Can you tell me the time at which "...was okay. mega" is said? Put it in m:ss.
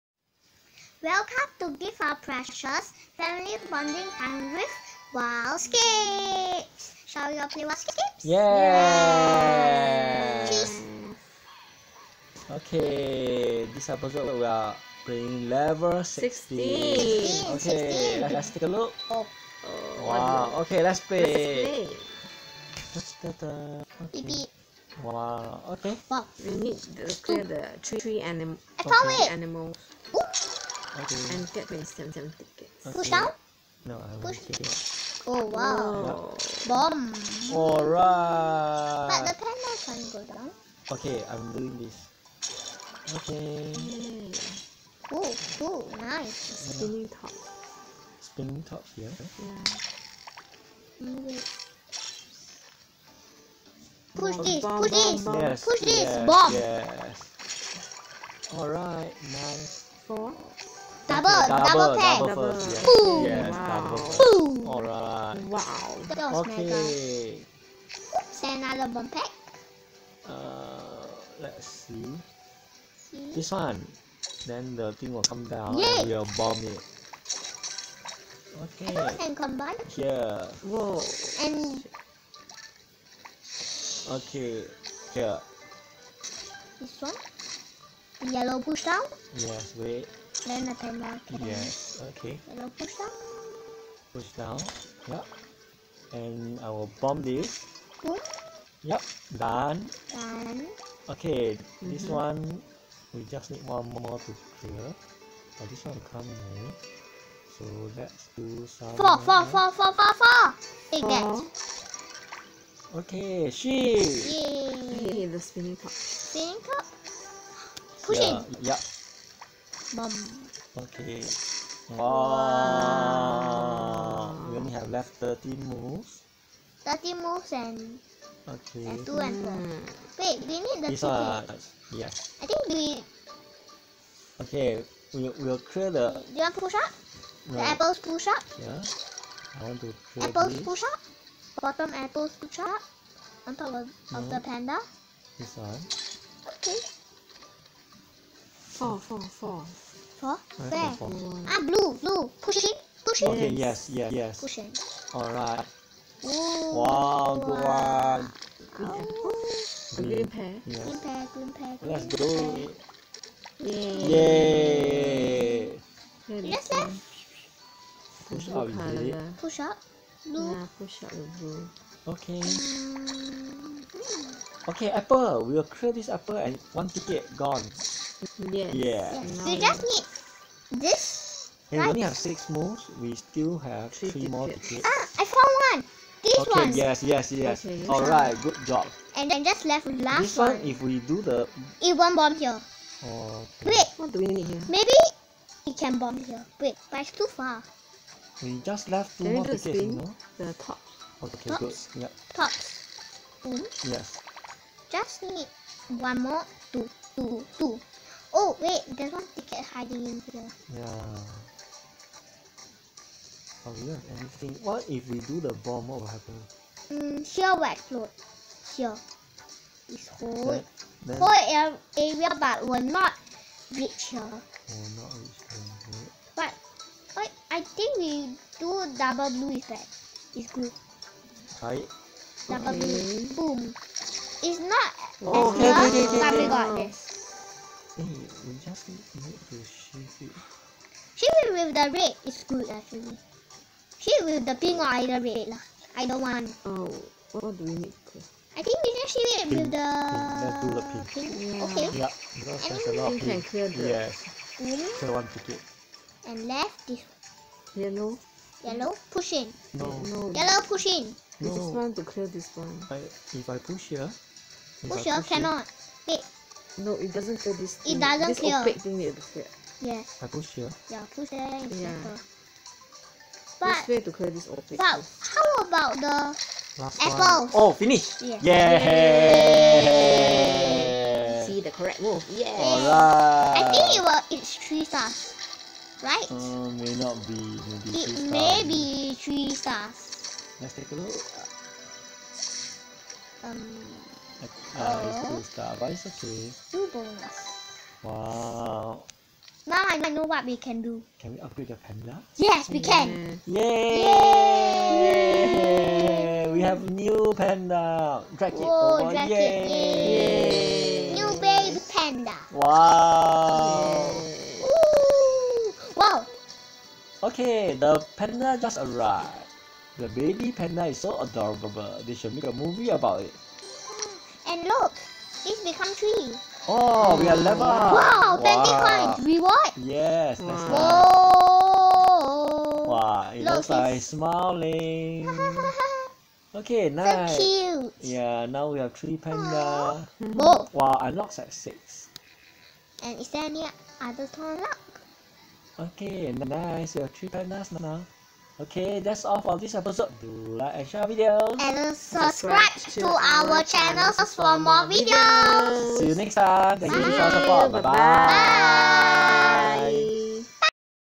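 1:06.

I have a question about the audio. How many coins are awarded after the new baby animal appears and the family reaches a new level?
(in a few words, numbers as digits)
20.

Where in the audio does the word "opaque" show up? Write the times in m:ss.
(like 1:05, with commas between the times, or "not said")
4:28, 4:34.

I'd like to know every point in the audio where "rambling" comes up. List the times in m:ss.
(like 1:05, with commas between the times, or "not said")
not said.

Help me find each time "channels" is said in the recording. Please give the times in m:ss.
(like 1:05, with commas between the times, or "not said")
5:53.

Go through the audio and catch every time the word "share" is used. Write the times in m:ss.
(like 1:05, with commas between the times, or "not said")
5:50.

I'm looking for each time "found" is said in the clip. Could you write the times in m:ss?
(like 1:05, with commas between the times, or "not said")
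3:05.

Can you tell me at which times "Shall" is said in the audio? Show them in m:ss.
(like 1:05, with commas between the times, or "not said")
0:07.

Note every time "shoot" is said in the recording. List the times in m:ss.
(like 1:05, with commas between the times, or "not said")
3:59, 4:04, 4:09.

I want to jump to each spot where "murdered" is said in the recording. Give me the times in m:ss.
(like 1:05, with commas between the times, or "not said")
not said.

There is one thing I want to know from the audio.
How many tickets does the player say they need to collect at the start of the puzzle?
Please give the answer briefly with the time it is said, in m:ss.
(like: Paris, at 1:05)
27, at 0:31.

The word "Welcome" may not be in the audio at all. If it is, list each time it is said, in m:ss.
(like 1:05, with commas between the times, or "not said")
0:01.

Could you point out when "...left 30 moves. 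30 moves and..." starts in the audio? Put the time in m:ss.
2:04.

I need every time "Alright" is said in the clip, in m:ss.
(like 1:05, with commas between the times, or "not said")
0:37, 0:58, 1:04, 2:35, 4:42.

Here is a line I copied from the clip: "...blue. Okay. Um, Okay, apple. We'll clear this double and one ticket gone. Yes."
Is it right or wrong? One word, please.
wrong.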